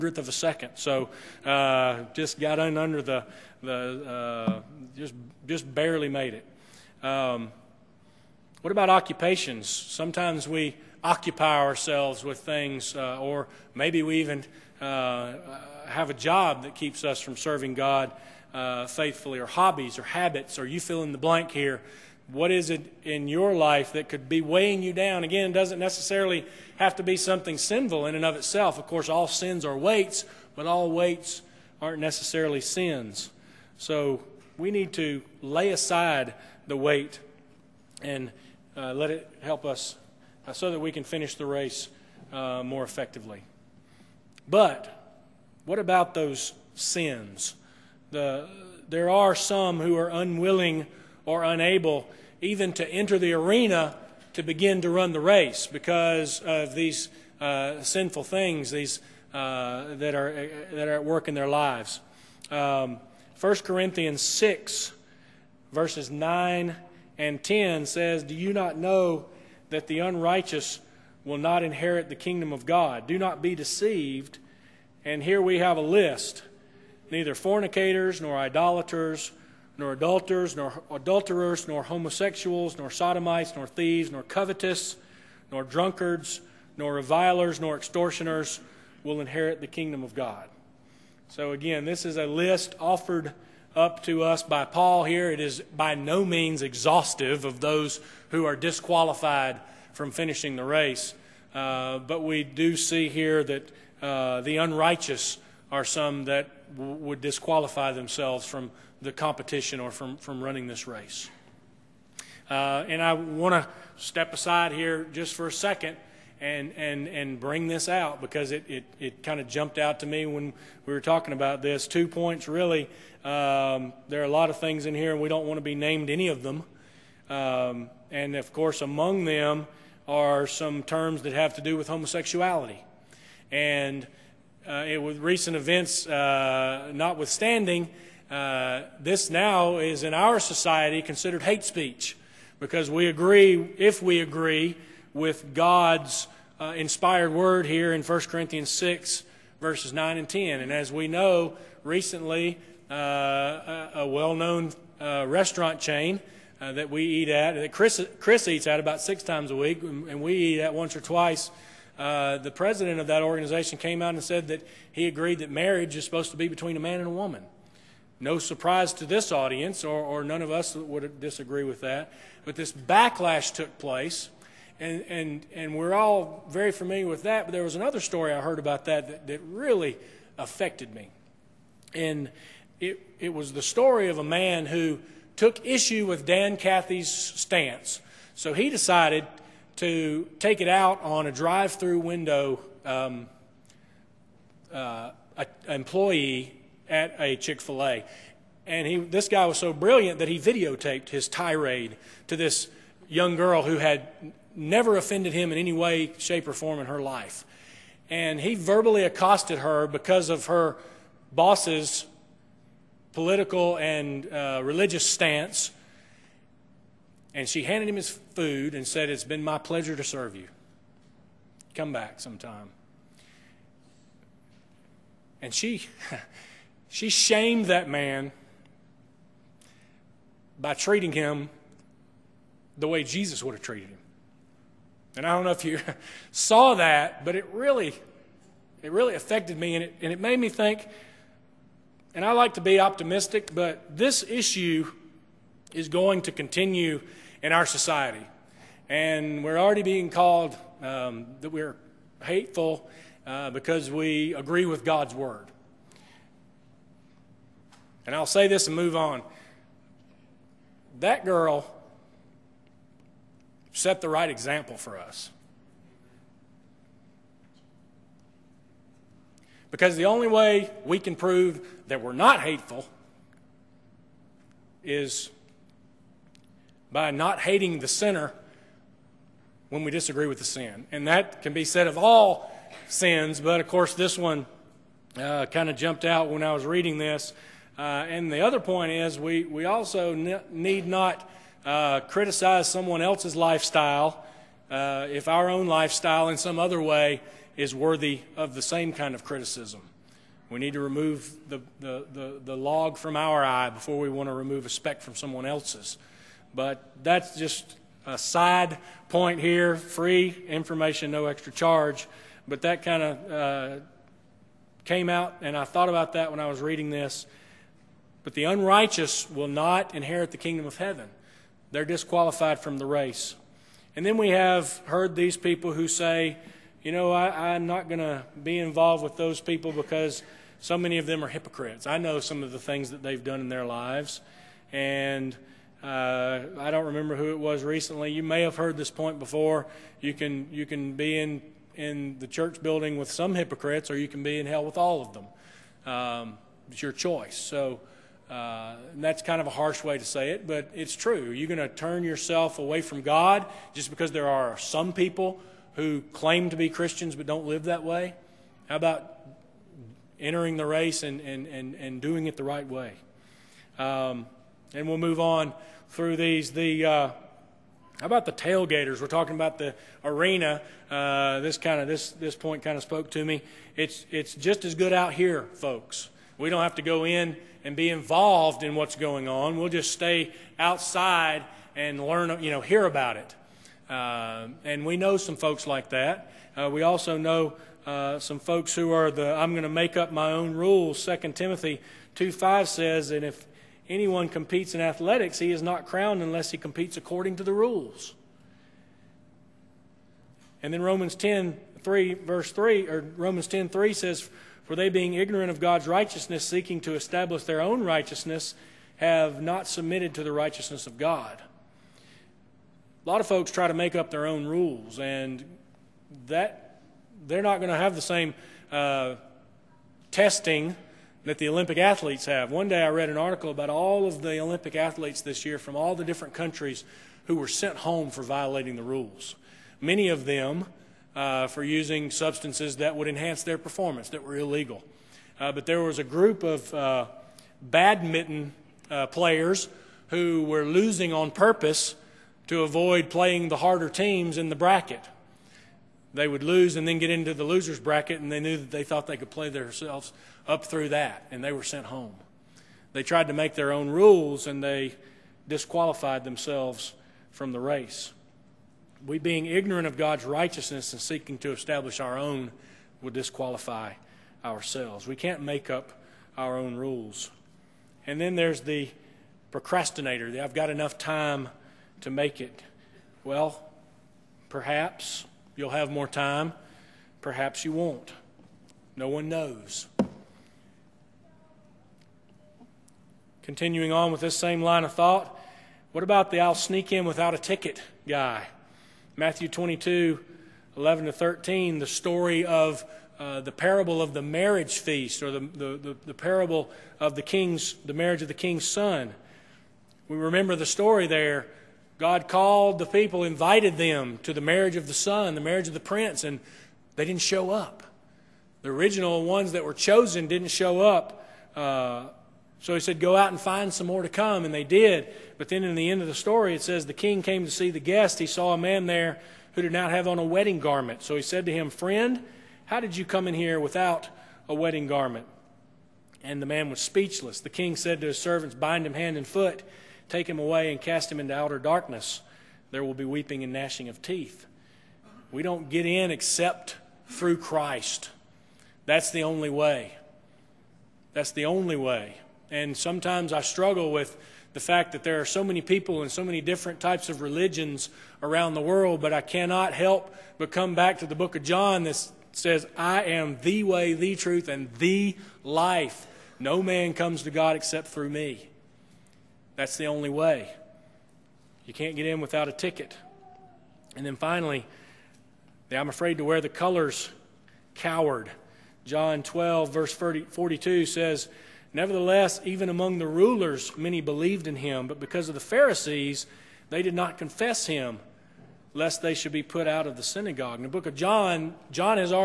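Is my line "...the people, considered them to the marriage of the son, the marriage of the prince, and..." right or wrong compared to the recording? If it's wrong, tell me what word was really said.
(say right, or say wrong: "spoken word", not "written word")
wrong: "invited", not "considered".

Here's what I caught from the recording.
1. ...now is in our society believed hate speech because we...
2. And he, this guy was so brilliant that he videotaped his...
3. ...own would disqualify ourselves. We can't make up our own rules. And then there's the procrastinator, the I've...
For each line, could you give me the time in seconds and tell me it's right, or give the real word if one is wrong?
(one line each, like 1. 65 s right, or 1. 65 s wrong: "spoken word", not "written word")
1. 139 s wrong: "considered", not "believed"
2. 198 s right
3. 462 s right.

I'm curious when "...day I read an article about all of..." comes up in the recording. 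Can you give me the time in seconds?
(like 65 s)
422 s.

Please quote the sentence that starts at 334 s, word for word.
And uh, I don't remember who it was recently.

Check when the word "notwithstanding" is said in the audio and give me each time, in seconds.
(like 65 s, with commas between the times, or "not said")
136 s.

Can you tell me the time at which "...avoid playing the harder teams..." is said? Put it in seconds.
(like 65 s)
442 s.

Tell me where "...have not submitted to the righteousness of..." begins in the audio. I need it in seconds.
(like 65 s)
408 s.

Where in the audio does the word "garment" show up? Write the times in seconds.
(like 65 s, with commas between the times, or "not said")
520 s, 524 s.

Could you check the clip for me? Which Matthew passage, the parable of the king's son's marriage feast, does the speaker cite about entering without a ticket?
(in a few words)
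Matthew 22:11-13.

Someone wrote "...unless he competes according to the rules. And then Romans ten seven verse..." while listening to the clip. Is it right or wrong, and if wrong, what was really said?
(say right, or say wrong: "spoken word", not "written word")
wrong: "three", not "seven".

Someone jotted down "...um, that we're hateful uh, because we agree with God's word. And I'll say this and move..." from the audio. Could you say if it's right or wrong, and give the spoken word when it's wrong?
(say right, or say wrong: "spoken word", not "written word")
right.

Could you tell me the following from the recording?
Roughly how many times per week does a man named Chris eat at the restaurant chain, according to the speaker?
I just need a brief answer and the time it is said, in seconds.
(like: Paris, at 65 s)
6, at 159 s.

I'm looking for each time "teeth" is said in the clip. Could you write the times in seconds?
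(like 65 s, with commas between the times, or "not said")
534 s.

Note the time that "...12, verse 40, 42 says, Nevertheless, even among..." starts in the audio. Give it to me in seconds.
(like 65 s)
569 s.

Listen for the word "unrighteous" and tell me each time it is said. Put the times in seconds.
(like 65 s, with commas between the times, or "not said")
69 s, 104 s, 318 s.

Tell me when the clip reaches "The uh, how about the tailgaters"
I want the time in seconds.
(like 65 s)
366 s.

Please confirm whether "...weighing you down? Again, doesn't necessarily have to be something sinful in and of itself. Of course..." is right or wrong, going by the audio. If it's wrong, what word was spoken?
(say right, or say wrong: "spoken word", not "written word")
right.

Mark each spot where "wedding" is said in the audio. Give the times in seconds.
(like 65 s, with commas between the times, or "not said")
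520 s, 524 s.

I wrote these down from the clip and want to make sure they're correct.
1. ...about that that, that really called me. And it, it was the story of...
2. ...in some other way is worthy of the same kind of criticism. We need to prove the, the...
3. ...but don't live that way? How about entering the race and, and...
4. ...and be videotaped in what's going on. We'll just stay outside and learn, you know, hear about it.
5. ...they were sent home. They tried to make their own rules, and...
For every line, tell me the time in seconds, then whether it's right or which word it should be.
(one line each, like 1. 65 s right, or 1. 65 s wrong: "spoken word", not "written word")
1. 178 s wrong: "affected", not "called"
2. 296 s wrong: "remove", not "prove"
3. 357 s right
4. 377 s wrong: "involved", not "videotaped"
5. 451 s right.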